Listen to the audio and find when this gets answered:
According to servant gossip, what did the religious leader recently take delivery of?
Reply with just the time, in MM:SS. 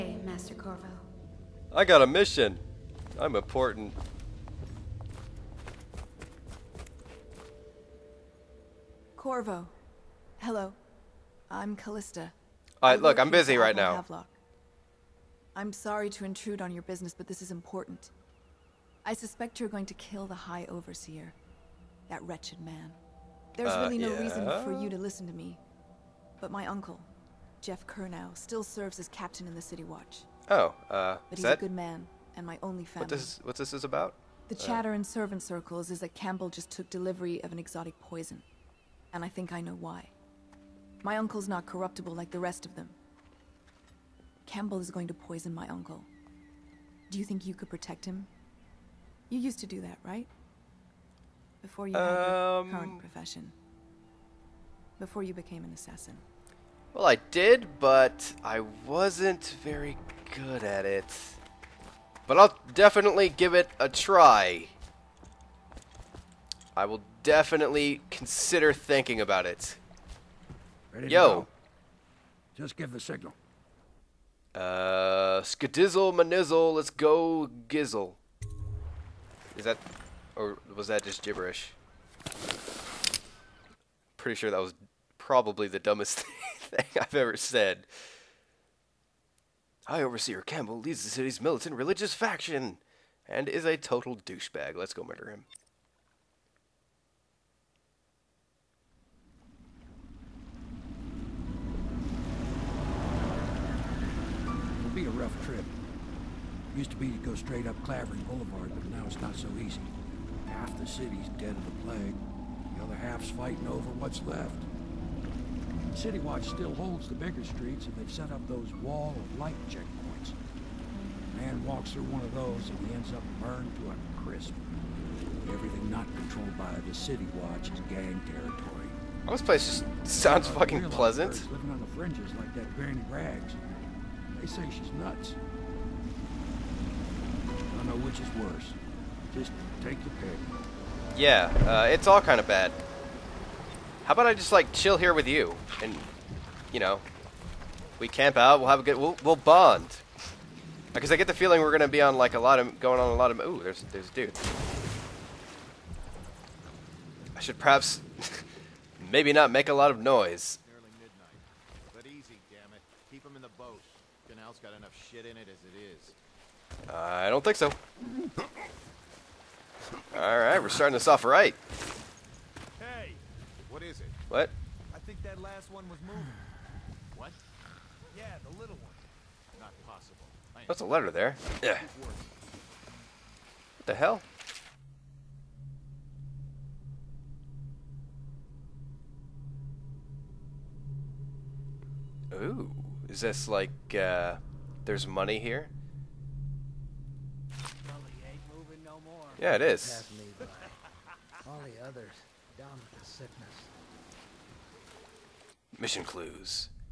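00:37.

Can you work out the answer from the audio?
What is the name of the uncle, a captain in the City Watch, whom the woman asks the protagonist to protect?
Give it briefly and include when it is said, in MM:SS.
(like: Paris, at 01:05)
Geoff Curnow, at 00:27.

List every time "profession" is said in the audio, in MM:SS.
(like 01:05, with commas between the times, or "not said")
00:52.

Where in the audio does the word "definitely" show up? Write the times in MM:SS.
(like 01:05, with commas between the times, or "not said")
01:02, 01:07.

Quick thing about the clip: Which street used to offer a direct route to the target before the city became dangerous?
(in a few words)
Clavering Boulevard.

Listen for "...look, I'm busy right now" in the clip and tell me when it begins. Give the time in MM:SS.
00:13.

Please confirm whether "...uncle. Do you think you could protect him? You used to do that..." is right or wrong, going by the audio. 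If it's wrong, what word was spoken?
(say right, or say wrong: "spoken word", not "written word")
right.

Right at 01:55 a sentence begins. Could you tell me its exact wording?
City Watch still holds the bigger streets and they've set up those wall of light checkpoints.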